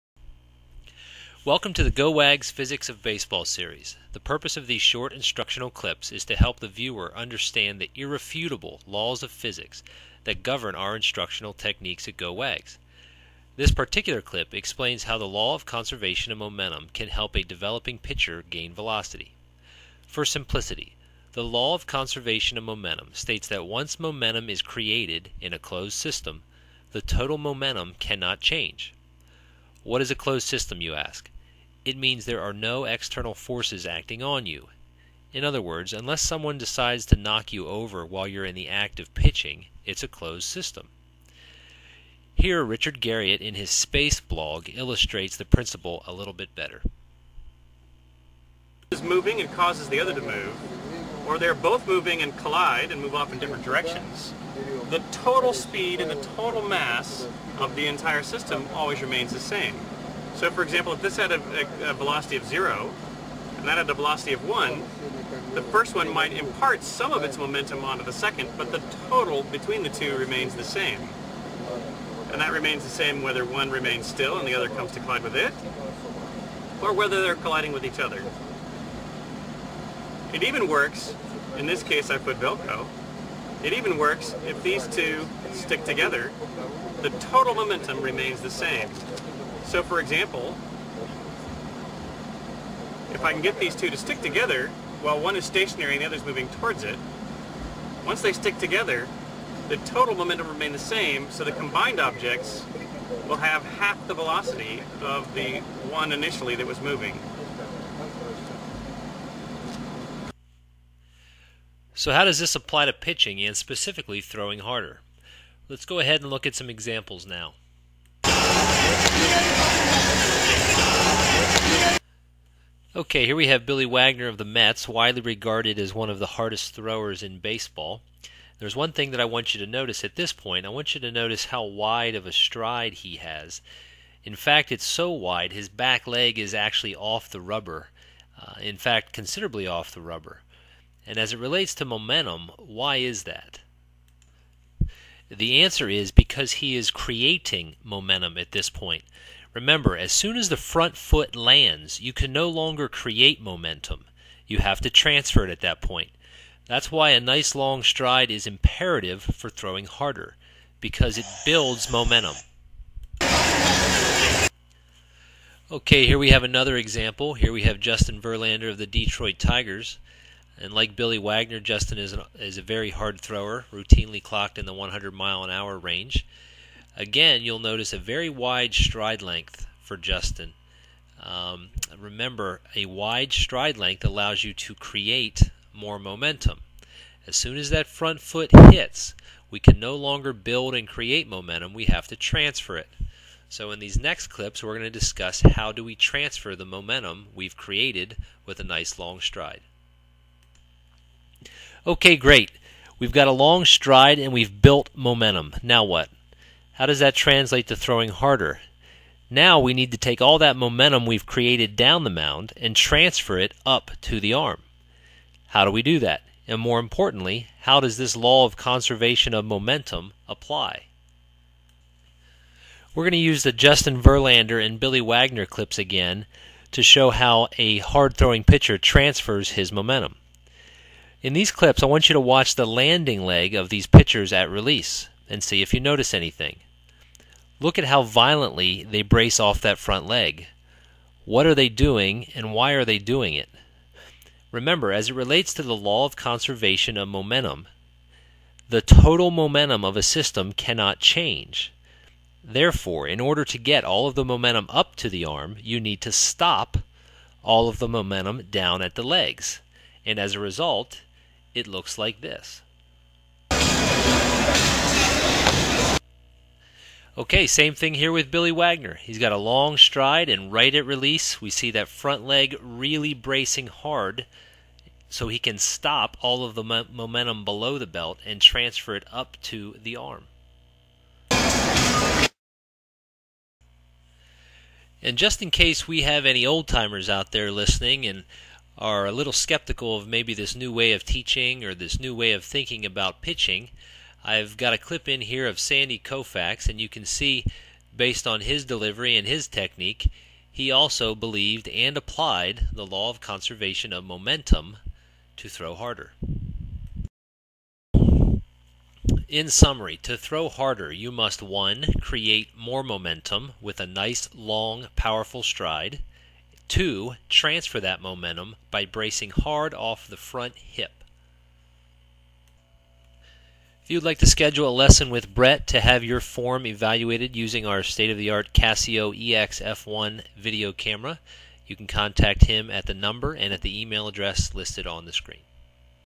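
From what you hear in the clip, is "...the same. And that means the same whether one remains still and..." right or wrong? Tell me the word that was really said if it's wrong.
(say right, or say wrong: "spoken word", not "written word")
wrong: "remains", not "means".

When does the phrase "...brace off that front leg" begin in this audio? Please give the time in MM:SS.
03:59.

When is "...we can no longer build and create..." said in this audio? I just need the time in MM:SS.
03:09.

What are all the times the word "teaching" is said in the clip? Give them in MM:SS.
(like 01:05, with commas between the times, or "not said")
04:51.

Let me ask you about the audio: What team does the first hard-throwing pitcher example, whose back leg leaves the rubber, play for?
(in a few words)
Mets.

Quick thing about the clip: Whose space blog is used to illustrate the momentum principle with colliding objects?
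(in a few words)
Richard Garriott.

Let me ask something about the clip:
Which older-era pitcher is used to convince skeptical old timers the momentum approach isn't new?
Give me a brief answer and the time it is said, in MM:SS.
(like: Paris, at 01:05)
Sandy Koufax, at 04:55.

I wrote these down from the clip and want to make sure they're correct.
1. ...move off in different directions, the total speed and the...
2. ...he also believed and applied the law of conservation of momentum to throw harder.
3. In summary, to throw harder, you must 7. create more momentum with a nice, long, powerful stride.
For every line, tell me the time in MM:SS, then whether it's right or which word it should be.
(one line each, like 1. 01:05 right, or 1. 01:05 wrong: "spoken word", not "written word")
1. 00:53 right
2. 05:00 right
3. 05:09 wrong: "1", not "7".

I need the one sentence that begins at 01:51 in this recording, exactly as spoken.
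So how does this apply to pitching and specifically throwing harder?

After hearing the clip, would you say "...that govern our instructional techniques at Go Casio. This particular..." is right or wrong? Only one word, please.
wrong.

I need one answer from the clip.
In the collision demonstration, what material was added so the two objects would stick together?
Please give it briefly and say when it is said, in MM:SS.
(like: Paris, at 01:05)
Velcro, at 01:22.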